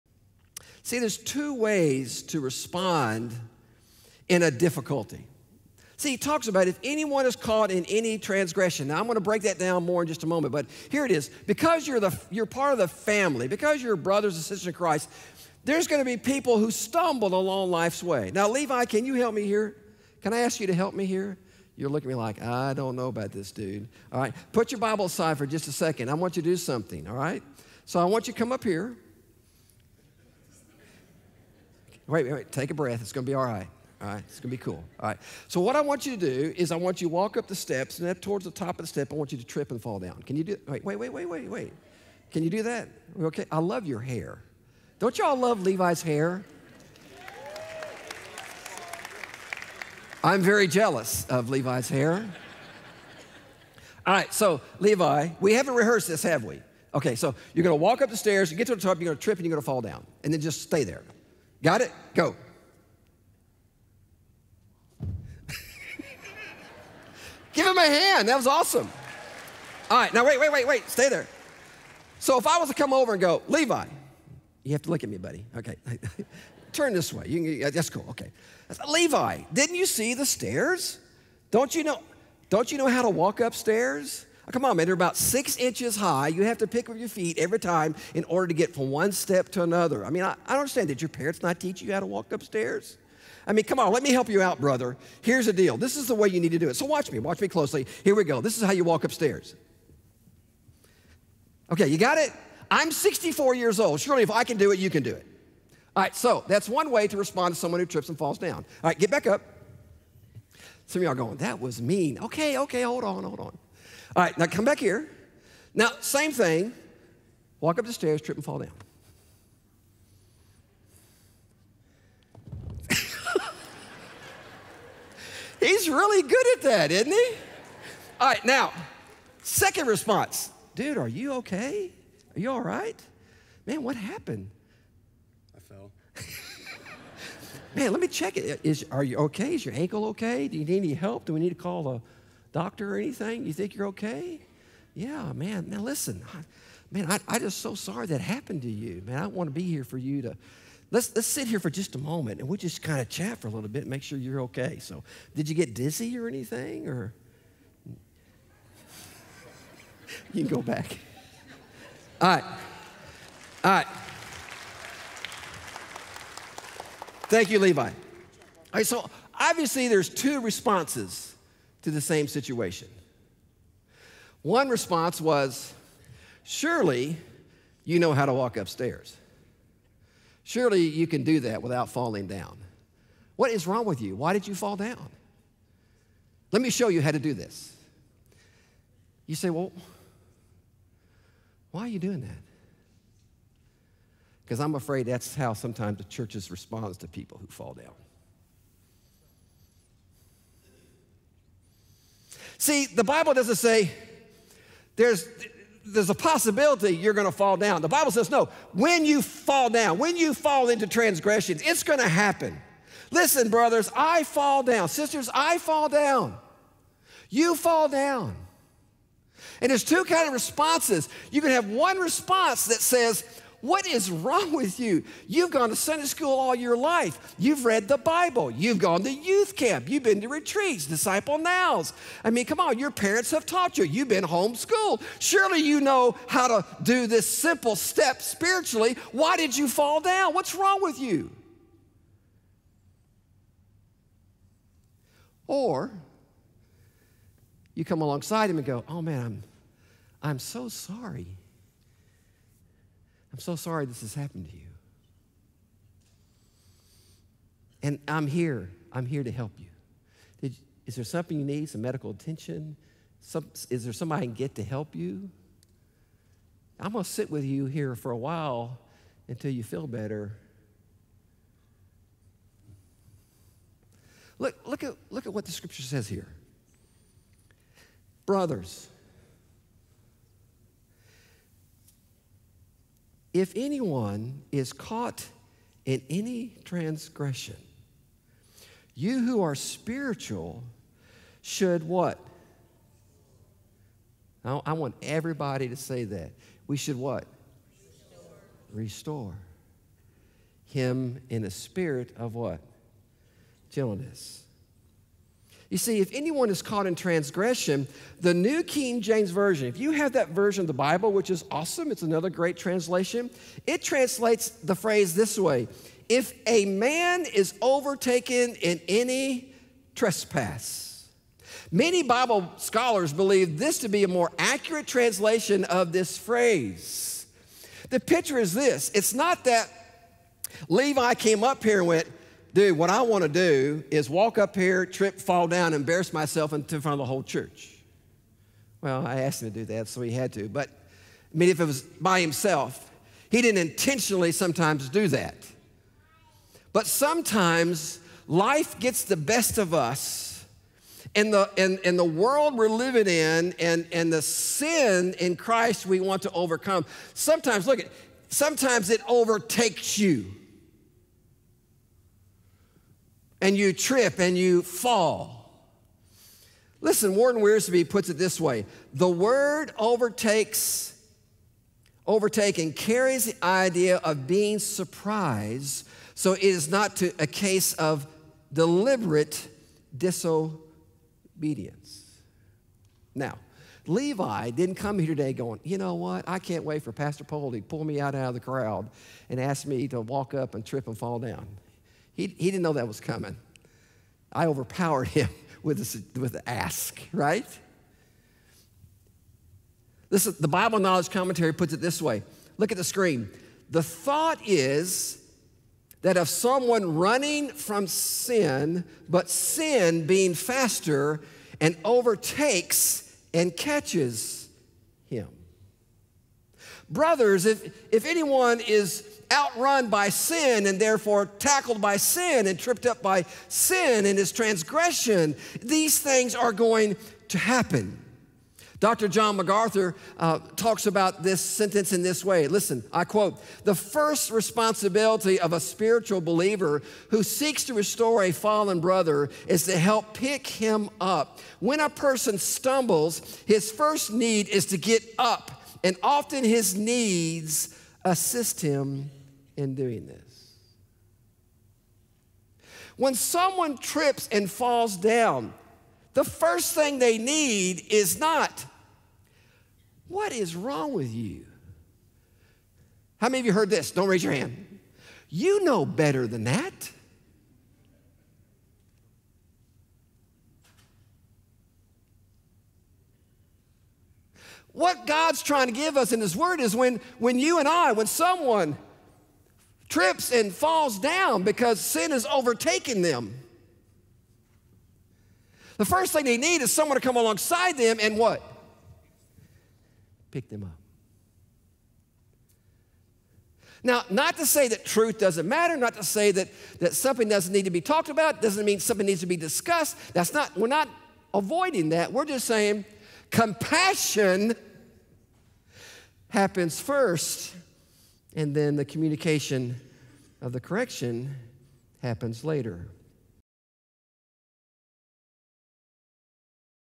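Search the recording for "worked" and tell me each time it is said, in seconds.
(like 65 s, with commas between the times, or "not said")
not said.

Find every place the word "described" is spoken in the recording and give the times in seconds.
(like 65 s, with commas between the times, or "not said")
not said.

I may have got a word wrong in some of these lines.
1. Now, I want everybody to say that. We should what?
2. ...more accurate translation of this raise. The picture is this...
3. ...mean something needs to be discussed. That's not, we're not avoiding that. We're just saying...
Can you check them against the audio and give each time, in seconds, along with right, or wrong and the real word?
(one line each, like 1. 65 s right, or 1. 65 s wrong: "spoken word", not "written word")
1. 294 s right
2. 324 s wrong: "phrase", not "raise"
3. 498 s right.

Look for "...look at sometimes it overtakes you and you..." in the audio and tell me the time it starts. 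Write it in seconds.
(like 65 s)
357 s.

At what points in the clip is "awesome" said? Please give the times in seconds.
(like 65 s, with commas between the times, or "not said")
68 s, 311 s.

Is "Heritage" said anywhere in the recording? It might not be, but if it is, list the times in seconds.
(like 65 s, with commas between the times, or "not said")
not said.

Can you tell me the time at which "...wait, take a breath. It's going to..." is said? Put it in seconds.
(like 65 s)
32 s.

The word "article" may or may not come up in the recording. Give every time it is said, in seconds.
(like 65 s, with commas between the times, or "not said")
not said.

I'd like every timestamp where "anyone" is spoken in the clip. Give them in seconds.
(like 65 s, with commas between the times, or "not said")
6 s, 283 s, 306 s, 418 s.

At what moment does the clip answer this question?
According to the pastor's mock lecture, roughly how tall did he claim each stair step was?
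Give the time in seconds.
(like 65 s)
85 s.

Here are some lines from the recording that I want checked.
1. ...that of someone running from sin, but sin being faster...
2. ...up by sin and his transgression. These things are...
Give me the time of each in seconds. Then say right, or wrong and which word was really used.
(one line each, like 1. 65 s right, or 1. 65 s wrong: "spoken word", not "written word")
1. 406 s right
2. 422 s right.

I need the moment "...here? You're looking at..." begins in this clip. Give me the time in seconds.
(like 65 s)
21 s.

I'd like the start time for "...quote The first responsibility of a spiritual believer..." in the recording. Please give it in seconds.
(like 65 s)
433 s.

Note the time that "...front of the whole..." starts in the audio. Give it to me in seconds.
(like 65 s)
336 s.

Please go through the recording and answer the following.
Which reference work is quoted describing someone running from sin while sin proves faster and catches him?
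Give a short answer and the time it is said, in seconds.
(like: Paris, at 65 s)
Bible Knowledge Commentary, at 400 s.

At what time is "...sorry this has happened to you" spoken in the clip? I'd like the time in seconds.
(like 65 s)
253 s.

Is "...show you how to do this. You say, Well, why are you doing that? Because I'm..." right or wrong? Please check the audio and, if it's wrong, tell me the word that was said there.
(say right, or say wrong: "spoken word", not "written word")
right.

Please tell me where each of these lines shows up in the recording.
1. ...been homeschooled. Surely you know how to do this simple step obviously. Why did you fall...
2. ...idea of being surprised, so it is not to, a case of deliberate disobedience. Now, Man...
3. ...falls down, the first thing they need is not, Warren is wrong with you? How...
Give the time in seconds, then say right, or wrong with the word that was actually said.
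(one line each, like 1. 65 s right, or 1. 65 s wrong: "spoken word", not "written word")
1. 234 s wrong: "spiritually", not "obviously"
2. 373 s wrong: "Levi", not "Man"
3. 454 s wrong: "What", not "Warren".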